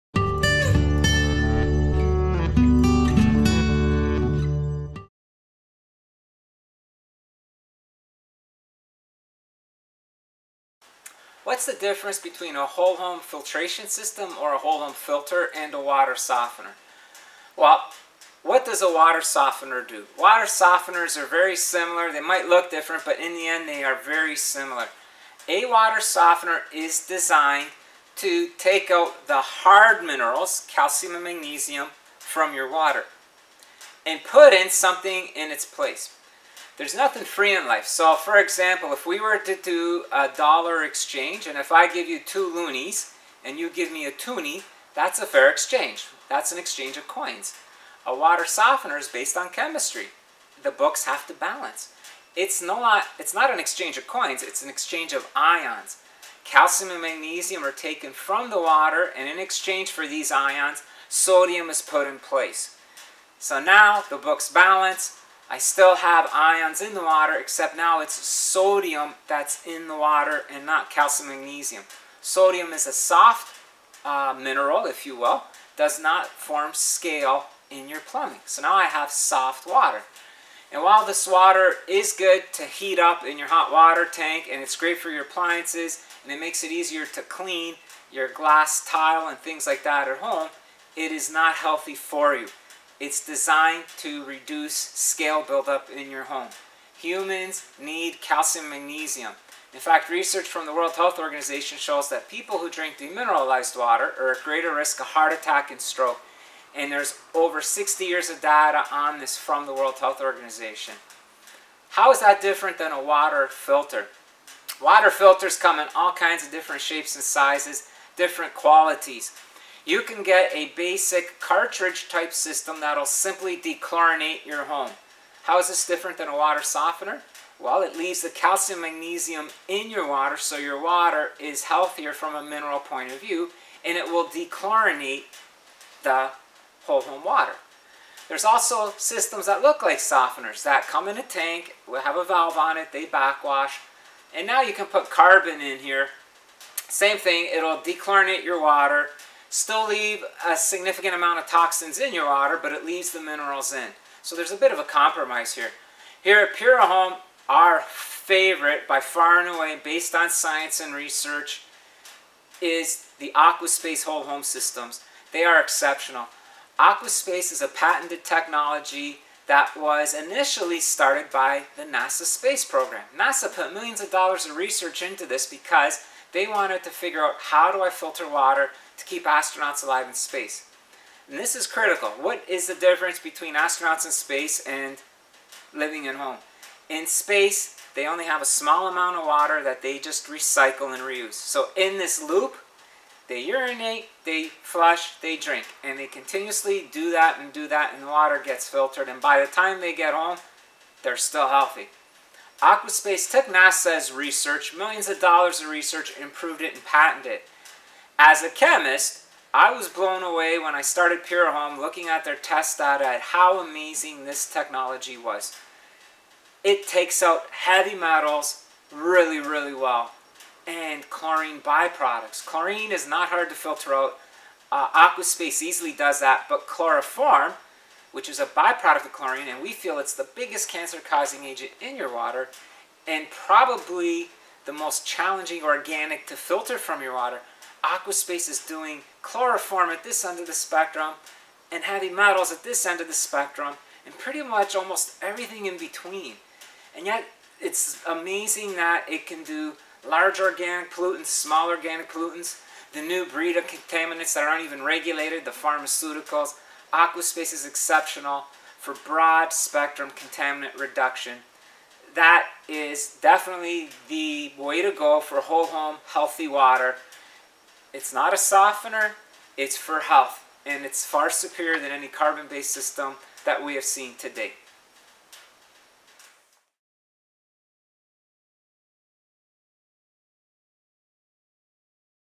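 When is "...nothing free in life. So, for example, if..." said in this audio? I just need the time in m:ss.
0:36.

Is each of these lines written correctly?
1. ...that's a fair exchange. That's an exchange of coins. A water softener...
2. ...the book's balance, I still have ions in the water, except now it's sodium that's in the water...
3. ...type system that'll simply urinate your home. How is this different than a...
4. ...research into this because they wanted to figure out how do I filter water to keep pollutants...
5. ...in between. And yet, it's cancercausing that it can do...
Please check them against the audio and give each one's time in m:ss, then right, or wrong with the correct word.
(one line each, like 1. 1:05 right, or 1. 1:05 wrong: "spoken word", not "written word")
1. 0:44 right
2. 1:04 right
3. 2:02 wrong: "dechlorinate", not "urinate"
4. 2:54 wrong: "astronauts", not "pollutants"
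5. 4:05 wrong: "amazing", not "cancercausing".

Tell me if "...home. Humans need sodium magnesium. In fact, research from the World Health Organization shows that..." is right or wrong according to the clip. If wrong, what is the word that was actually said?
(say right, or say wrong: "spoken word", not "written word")
wrong: "calcium", not "sodium".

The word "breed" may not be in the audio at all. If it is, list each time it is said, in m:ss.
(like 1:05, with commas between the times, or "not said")
4:13.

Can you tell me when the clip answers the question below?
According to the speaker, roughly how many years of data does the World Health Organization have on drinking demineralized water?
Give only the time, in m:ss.
1:47.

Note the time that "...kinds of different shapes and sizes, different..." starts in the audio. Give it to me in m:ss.
1:56.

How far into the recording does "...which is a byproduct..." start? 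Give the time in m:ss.
3:48.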